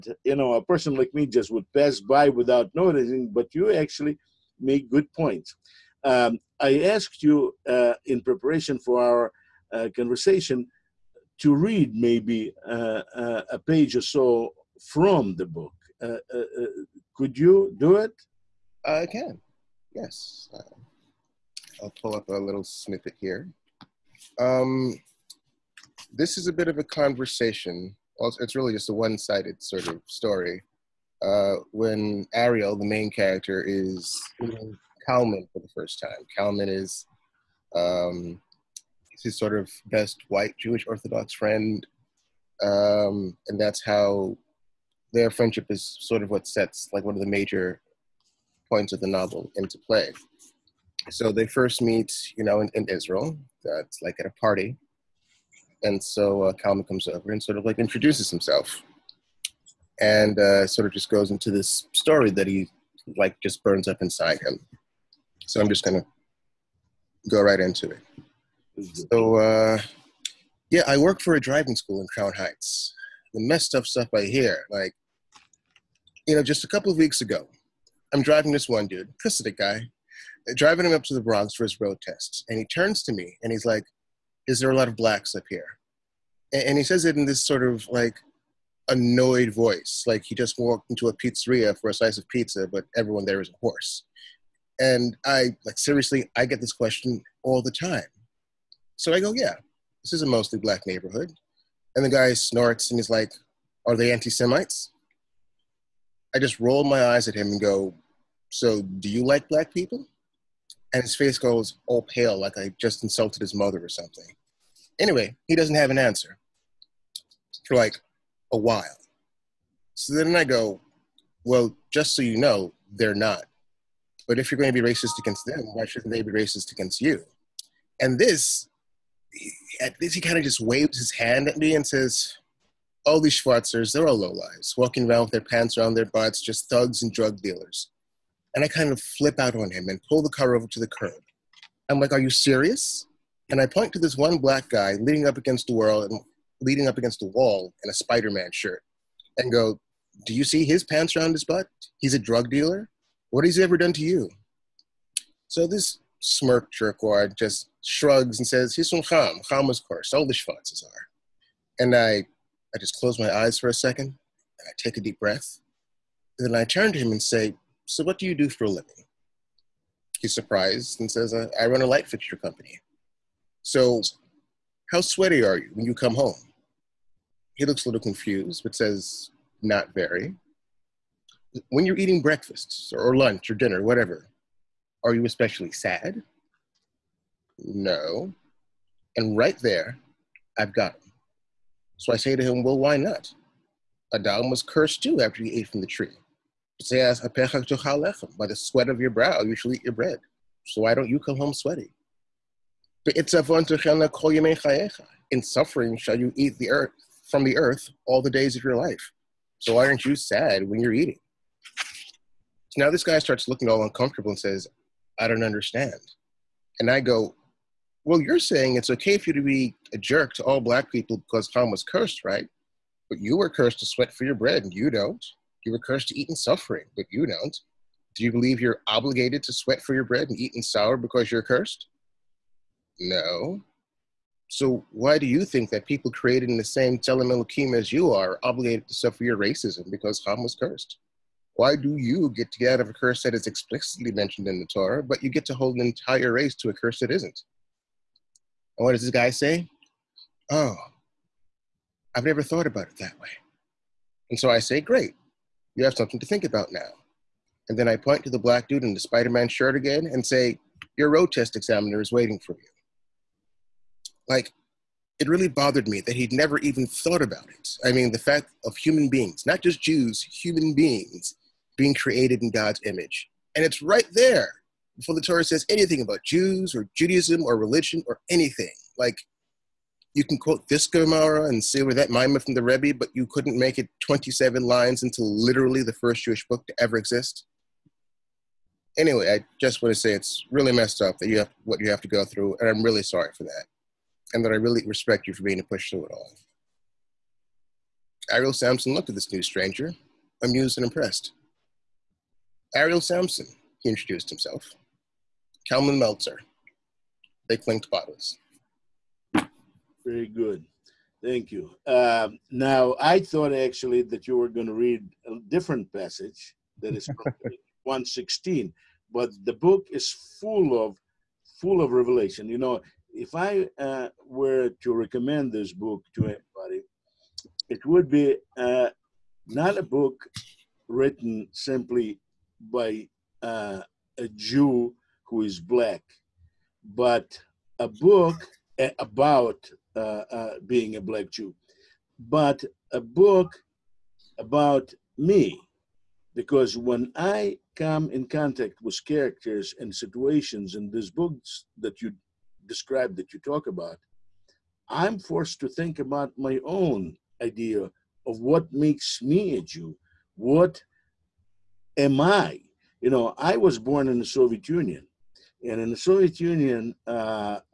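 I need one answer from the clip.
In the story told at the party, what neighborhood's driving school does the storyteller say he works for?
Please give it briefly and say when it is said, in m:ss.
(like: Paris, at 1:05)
Crown Heights, at 1:12.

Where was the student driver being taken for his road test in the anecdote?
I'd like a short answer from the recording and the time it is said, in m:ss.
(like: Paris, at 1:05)
The Bronx, at 1:21.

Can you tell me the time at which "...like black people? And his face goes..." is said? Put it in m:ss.
1:49.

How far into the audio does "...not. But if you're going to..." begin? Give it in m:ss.
2:03.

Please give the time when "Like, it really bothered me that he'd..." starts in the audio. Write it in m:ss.
4:24.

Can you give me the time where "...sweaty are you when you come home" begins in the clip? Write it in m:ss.
2:55.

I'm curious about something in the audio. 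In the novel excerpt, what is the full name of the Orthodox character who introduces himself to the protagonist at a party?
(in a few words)
Kalman Meltzer.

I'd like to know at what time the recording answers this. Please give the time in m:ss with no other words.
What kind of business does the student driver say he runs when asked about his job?
2:51.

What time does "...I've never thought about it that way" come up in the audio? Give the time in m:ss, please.
4:12.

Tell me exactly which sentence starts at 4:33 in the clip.
And it's right there before the Torah says anything about Jews or Judaism or religion or anything.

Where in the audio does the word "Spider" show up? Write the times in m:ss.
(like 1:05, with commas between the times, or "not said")
2:27, 4:19.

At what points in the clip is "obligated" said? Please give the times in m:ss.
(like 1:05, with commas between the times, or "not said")
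3:48, 3:58.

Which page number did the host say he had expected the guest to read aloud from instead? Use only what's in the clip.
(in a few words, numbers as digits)
116.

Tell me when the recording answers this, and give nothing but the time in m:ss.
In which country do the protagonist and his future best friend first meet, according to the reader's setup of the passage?
0:52.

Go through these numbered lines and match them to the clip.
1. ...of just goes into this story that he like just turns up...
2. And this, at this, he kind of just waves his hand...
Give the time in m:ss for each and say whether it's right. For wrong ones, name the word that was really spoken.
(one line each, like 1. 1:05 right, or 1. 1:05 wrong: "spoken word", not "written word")
1. 1:00 wrong: "burns", not "turns"
2. 2:08 right.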